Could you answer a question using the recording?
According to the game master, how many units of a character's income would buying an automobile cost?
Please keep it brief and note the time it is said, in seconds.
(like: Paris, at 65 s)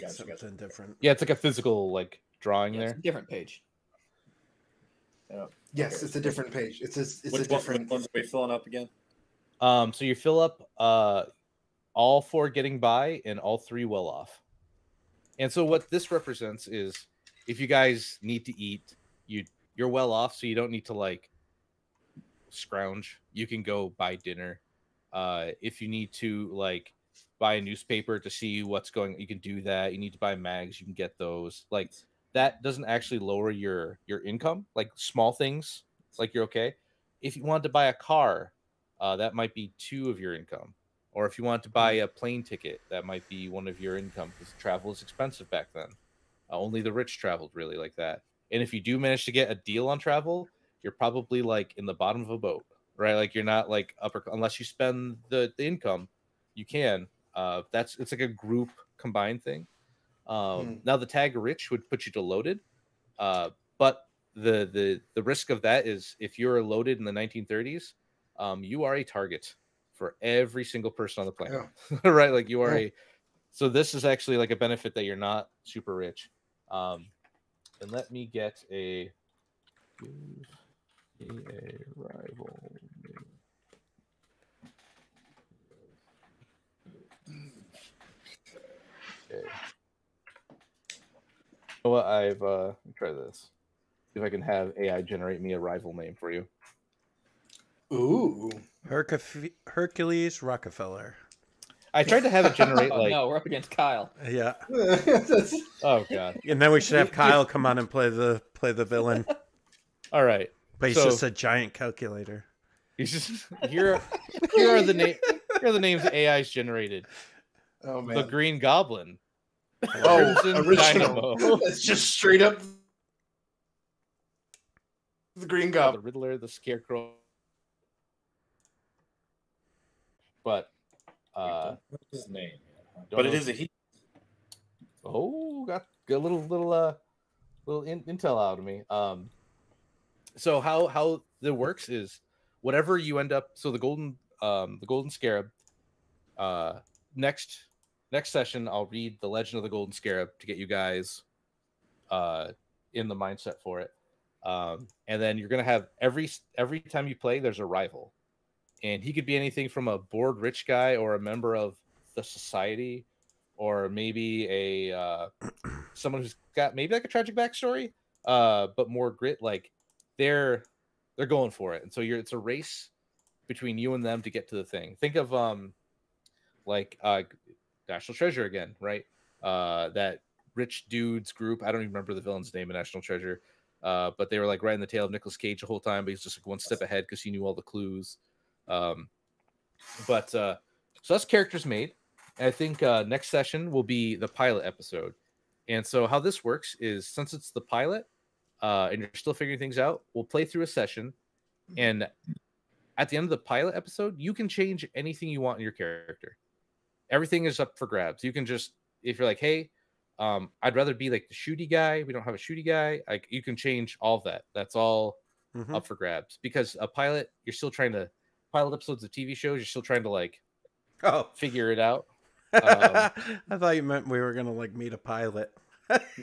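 2, at 39 s.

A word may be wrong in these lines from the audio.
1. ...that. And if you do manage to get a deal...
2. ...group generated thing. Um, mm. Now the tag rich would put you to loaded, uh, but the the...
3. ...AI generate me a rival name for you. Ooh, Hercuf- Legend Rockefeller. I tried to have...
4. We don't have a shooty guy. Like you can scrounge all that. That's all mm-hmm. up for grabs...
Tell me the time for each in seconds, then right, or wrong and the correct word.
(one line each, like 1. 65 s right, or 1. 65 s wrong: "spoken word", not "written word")
1. 47 s right
2. 58 s wrong: "combined", not "generated"
3. 94 s wrong: "Hercules", not "Legend"
4. 212 s wrong: "change", not "scrounge".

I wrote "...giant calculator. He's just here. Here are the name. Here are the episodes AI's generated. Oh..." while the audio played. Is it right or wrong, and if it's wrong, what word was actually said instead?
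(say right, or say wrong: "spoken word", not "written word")
wrong: "names", not "episodes".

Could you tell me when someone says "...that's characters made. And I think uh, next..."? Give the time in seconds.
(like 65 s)
191 s.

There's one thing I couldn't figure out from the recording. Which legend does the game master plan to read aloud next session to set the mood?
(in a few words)
The Legend of the Golden Scarab.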